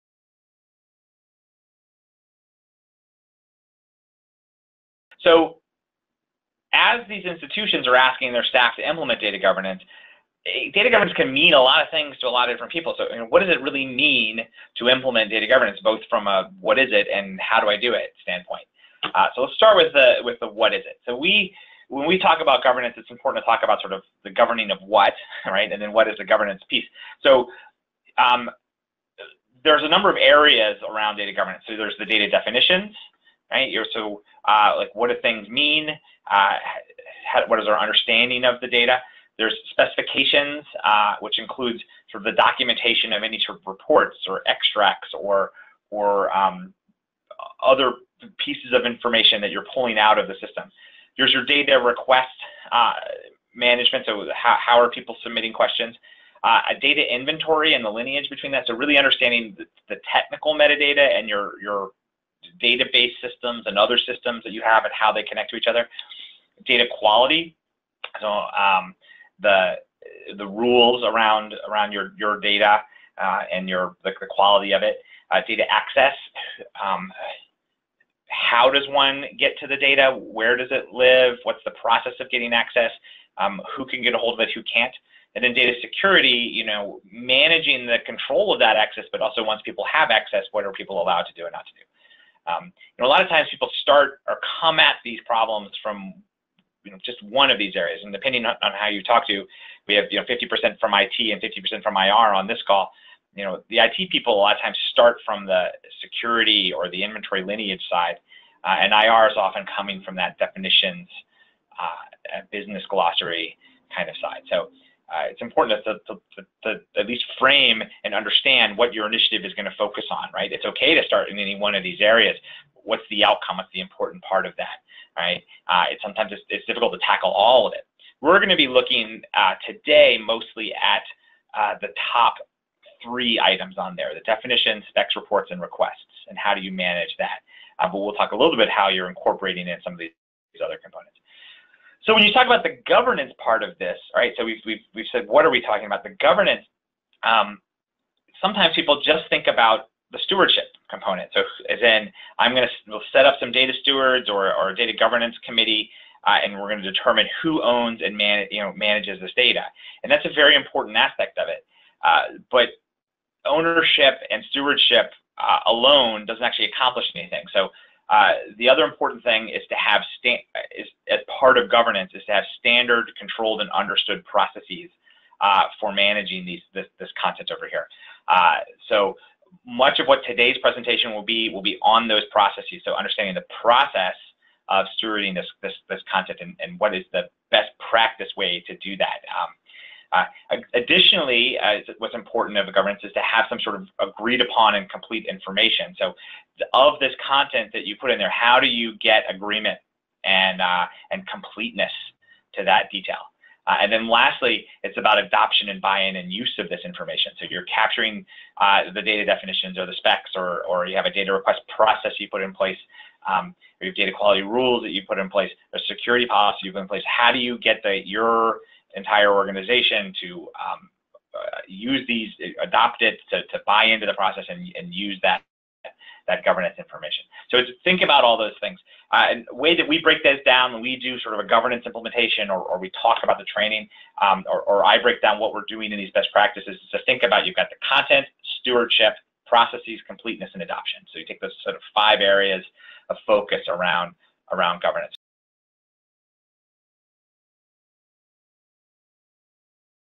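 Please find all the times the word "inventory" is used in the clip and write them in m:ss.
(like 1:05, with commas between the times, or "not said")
0:57, 1:47.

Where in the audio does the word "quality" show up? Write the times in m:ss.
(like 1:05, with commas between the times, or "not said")
1:06, 1:14, 3:34.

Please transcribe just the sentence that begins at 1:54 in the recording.
So uh, it's important to, to, to, to, at least frame and understand what your initiative is going to focus on, right?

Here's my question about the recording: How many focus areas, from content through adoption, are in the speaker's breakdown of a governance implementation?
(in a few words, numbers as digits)
5.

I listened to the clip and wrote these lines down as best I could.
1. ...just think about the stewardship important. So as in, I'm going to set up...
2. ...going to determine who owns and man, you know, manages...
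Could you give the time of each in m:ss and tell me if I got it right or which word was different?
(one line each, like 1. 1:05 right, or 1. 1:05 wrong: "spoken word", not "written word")
1. 2:29 wrong: "component", not "important"
2. 2:36 right.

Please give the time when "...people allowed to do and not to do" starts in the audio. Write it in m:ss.
1:30.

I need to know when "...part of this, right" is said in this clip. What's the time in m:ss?
2:23.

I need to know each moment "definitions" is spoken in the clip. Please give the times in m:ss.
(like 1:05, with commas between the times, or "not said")
0:32, 1:50, 2:14, 3:29.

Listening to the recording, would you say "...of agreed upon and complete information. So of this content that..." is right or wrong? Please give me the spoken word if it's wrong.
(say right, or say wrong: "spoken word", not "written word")
right.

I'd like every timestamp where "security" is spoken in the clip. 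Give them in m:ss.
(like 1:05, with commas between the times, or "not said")
1:25, 1:46, 3:35.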